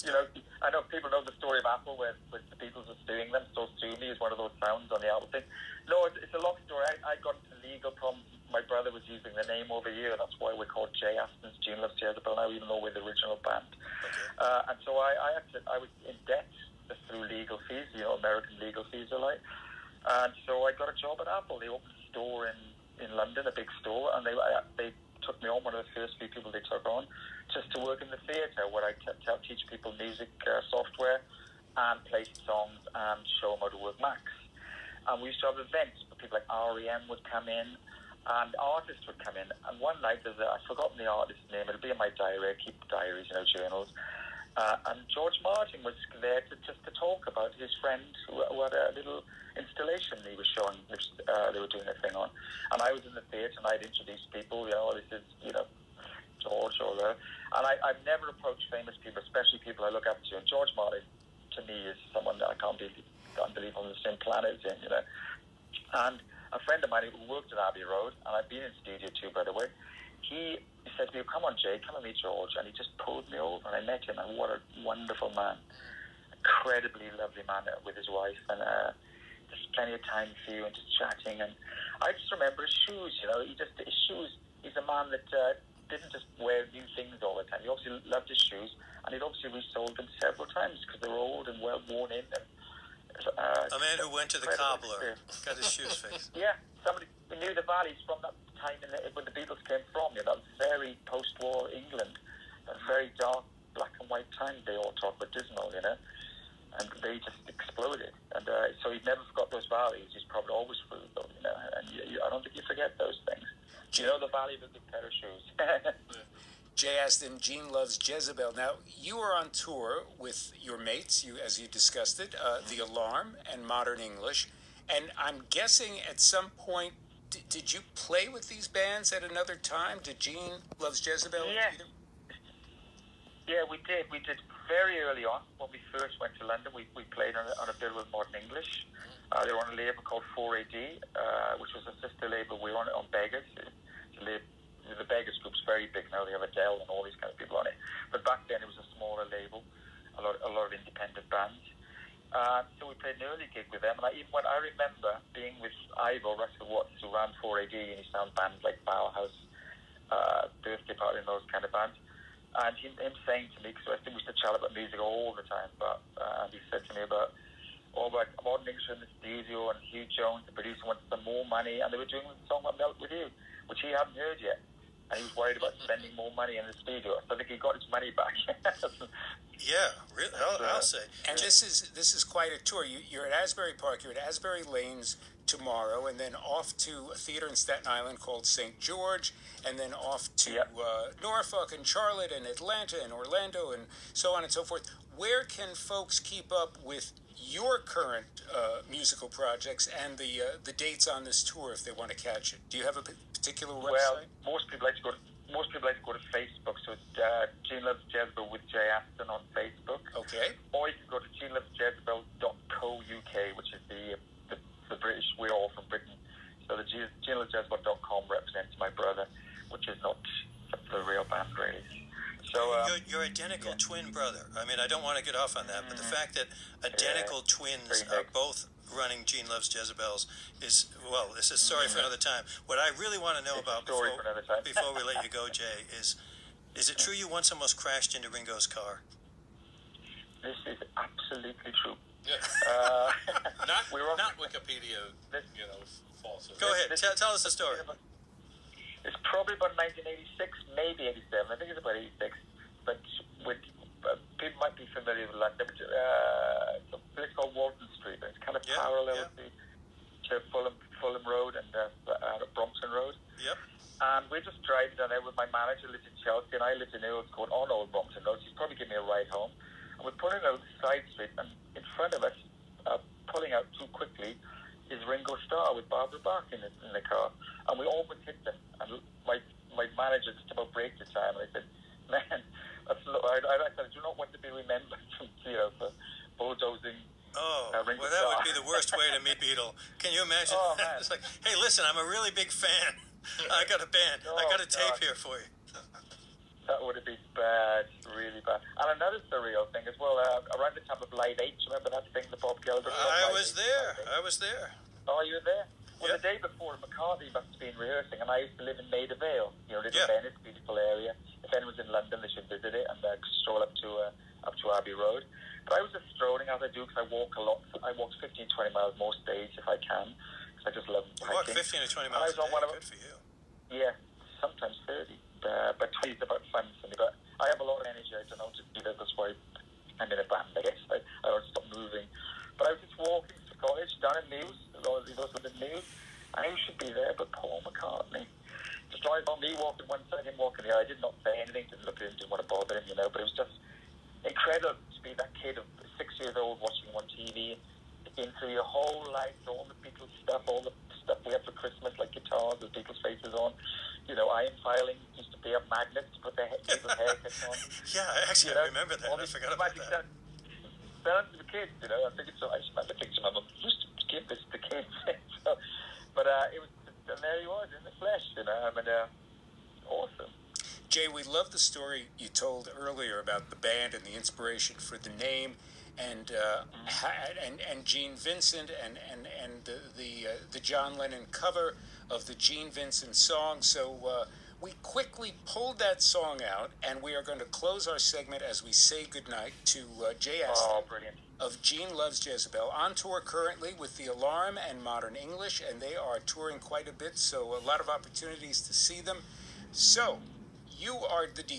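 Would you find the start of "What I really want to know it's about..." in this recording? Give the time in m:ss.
3:52.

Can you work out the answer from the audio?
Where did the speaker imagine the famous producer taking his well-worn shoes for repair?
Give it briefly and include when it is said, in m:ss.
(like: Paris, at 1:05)
the cobbler, at 1:34.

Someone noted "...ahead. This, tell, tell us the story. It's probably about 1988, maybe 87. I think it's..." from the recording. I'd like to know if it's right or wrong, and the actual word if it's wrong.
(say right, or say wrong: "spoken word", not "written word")
wrong: "1986", not "1988".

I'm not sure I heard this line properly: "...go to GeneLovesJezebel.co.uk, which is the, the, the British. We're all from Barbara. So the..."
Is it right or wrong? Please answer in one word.
wrong.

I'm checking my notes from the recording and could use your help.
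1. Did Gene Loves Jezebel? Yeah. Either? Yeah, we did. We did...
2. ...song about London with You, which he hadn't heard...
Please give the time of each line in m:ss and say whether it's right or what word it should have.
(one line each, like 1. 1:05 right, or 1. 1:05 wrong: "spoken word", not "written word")
1. 2:10 right
2. 2:52 wrong: "Melt", not "London".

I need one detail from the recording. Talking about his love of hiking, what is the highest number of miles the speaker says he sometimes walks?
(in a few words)
30.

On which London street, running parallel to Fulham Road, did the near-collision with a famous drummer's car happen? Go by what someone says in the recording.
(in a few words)
Walton Street.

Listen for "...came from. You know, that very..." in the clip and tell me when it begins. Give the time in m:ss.
1:39.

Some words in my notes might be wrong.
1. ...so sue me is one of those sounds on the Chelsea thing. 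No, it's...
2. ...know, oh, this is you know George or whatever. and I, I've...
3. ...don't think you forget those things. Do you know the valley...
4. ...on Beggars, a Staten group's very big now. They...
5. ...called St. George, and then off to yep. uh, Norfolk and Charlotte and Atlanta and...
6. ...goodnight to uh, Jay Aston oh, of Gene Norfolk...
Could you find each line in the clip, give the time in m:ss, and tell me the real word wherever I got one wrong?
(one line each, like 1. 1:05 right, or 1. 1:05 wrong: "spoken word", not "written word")
1. 0:03 wrong: "Apple", not "Chelsea"
2. 0:54 right
3. 1:52 right
4. 2:22 wrong: "Beggars", not "Staten"
5. 3:08 right
6. 6:29 wrong: "Loves", not "Norfolk".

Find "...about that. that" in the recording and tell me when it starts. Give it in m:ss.
5:59.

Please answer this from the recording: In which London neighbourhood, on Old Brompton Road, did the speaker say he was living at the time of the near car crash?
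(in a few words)
Earls Court.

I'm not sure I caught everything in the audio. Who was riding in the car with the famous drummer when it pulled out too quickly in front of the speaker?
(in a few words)
Barbara Bach.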